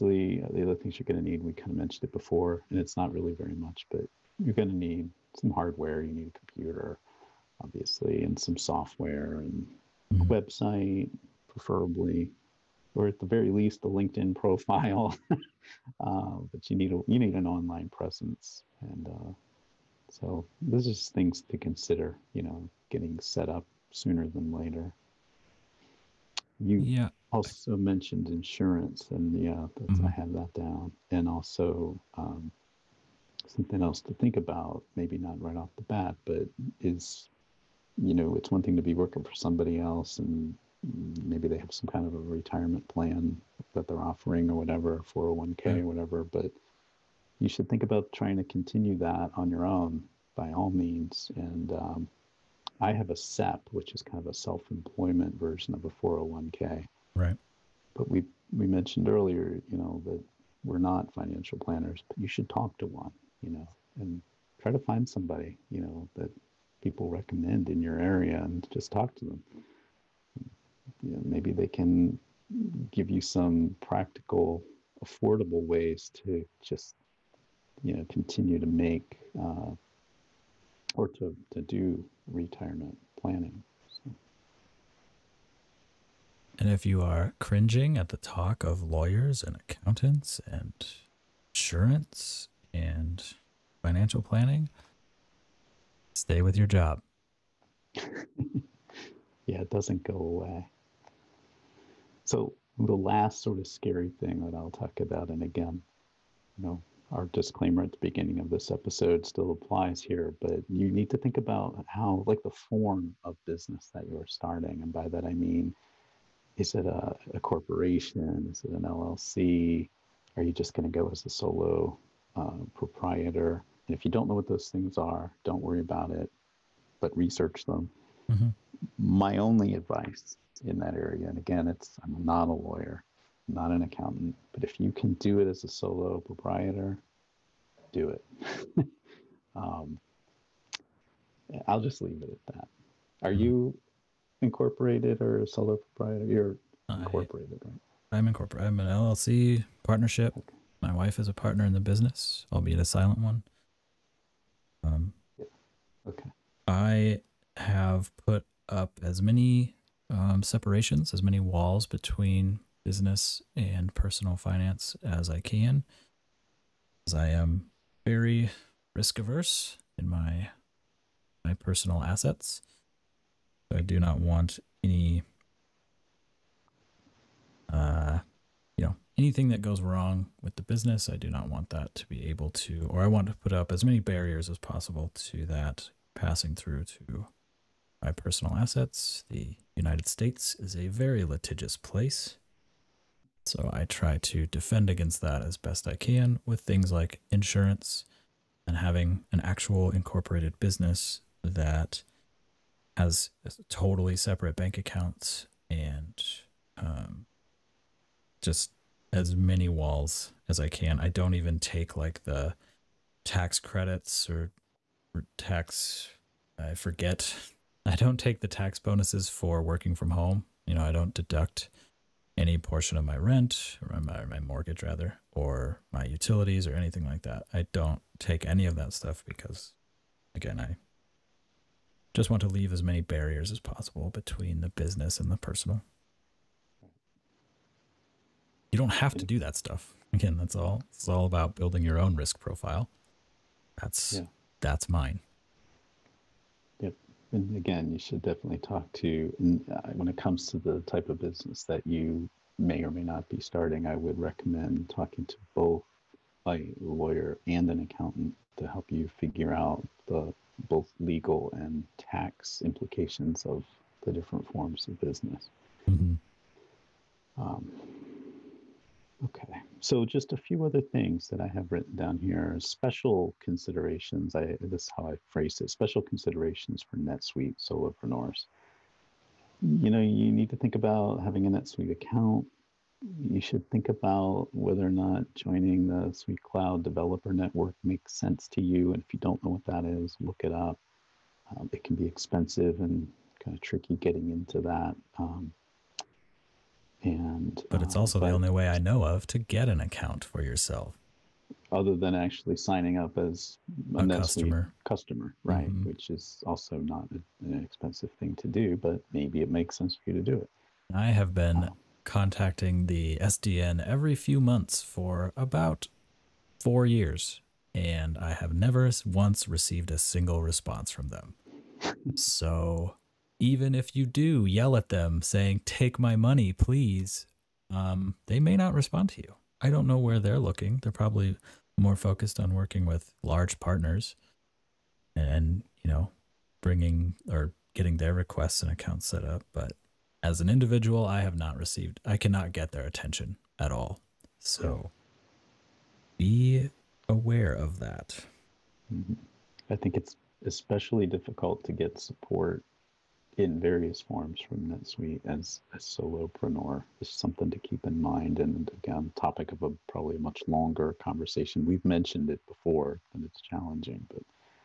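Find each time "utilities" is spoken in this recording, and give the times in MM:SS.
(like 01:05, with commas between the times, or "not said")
03:46.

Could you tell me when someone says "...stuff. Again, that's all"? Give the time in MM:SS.
03:59.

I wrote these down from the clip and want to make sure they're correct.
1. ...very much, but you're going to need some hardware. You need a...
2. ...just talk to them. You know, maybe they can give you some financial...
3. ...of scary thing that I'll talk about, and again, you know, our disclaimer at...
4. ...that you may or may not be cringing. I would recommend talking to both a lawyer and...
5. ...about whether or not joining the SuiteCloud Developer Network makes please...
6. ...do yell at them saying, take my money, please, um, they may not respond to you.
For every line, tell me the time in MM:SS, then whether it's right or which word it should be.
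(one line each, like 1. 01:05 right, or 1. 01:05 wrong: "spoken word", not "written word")
1. 00:03 right
2. 01:08 wrong: "practical", not "financial"
3. 01:43 right
4. 04:11 wrong: "starting", not "cringing"
5. 04:43 wrong: "sense", not "please"
6. 05:24 right.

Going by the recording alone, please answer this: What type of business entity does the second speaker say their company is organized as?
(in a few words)
LLC partnership.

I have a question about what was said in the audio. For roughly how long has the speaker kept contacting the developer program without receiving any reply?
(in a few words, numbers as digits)
4 years.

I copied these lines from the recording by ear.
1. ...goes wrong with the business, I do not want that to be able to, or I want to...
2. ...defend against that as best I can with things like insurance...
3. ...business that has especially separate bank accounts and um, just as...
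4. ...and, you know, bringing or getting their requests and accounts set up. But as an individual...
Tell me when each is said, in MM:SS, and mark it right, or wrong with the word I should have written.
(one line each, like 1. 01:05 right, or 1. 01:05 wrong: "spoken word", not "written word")
1. 02:59 right
2. 03:14 right
3. 03:20 wrong: "totally", not "especially"
4. 05:35 right.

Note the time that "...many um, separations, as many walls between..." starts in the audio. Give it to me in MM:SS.
02:39.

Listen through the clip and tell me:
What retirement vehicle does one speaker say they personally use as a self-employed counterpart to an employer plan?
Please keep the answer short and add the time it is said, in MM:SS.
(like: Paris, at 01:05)
SEP, at 00:53.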